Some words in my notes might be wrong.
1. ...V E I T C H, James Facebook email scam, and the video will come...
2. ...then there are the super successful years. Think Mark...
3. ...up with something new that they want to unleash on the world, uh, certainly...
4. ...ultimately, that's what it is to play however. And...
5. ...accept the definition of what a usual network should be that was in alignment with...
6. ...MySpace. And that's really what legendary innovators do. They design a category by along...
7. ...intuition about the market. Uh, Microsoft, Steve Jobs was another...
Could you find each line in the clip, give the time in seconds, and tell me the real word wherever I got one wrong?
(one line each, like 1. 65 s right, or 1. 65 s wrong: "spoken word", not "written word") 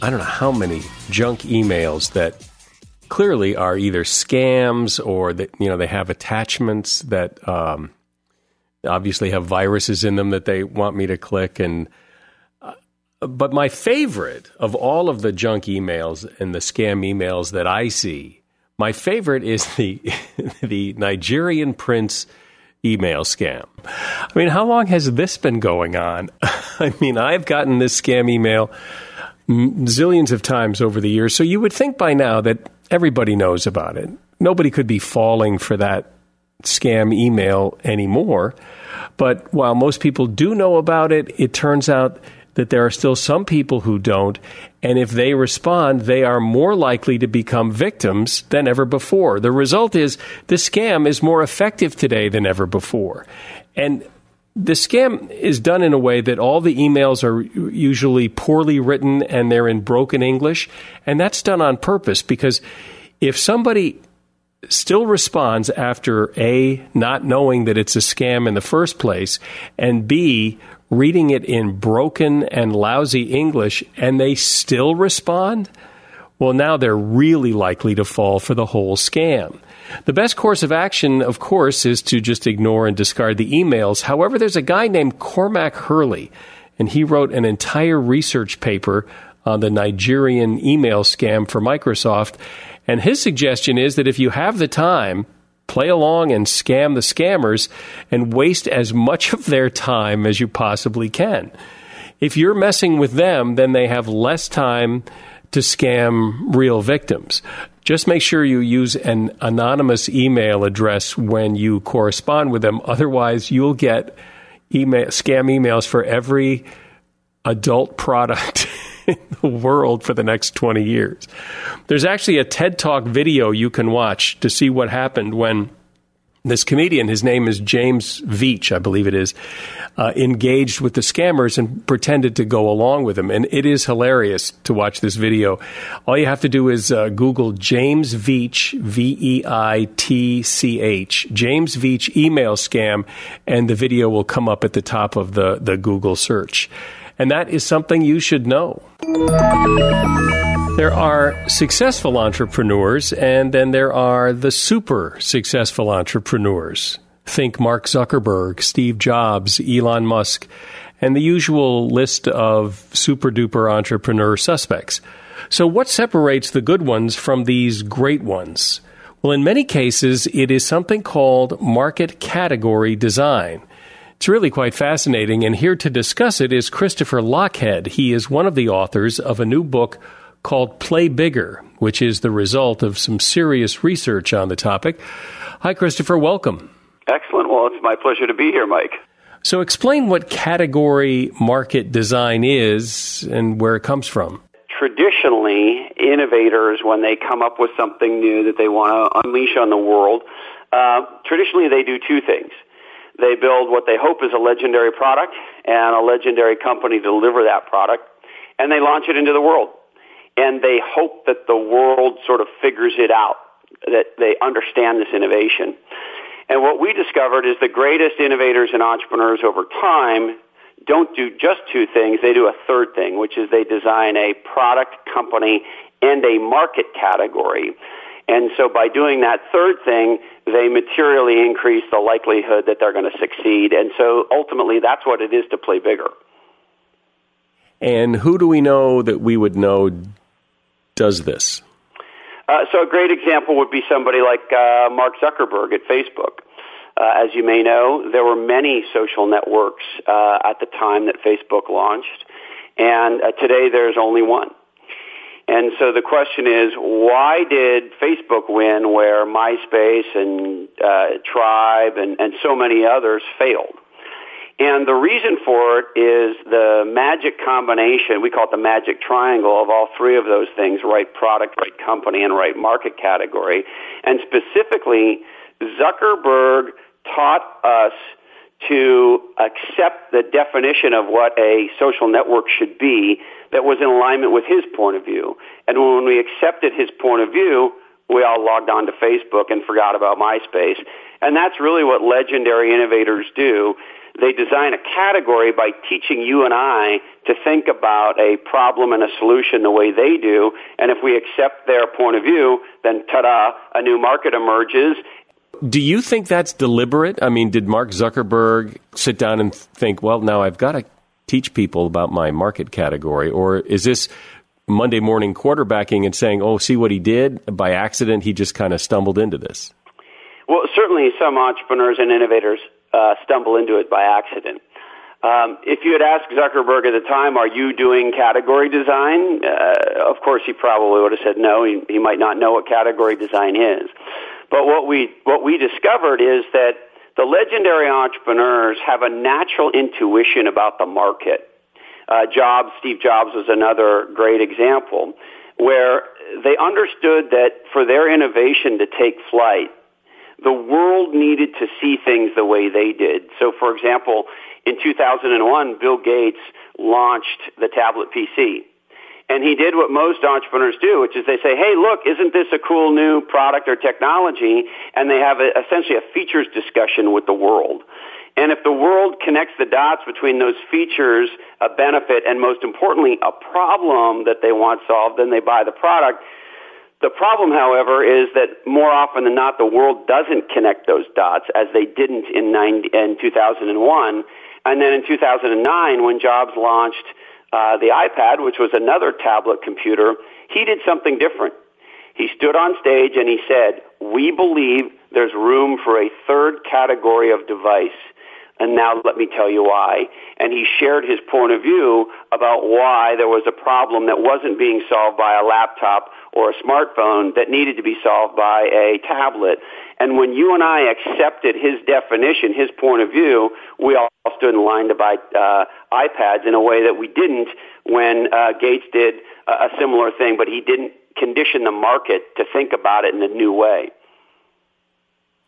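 1. 138 s wrong: "Veitch", not "Facebook"
2. 153 s wrong: "entrepreneurs", not "years"
3. 197 s wrong: "traditionally", not "certainly"
4. 234 s wrong: "bigger", not "however"
5. 279 s wrong: "social", not "usual"
6. 290 s wrong: "teaching", not "along"
7. 339 s wrong: "Jobs", not "Microsoft".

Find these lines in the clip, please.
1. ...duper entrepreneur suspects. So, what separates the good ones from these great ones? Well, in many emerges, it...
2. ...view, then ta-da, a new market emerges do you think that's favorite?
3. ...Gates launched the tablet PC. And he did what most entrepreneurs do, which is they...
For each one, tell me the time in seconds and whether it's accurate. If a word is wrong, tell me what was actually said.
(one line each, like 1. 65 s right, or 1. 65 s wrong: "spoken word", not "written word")
1. 163 s wrong: "cases", not "emerges"
2. 302 s wrong: "deliberate", not "favorite"
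3. 355 s right.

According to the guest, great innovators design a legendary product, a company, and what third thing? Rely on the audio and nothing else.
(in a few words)
a market category.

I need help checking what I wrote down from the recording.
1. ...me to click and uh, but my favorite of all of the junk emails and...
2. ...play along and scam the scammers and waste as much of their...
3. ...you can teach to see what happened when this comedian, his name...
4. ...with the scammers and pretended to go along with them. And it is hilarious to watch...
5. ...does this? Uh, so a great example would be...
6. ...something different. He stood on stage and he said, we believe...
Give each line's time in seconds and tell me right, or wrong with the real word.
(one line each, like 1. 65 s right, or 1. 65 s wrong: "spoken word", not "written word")
1. 10 s right
2. 95 s right
3. 123 s wrong: "watch", not "teach"
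4. 130 s right
5. 240 s right
6. 390 s right.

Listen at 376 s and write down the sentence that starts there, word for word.
The problem, however, is that more often than not, the world doesn't connect those dots as they didn't in, 90, in 2001.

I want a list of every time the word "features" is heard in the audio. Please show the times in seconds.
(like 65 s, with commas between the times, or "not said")
366 s, 370 s.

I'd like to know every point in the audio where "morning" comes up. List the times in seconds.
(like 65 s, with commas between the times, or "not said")
314 s.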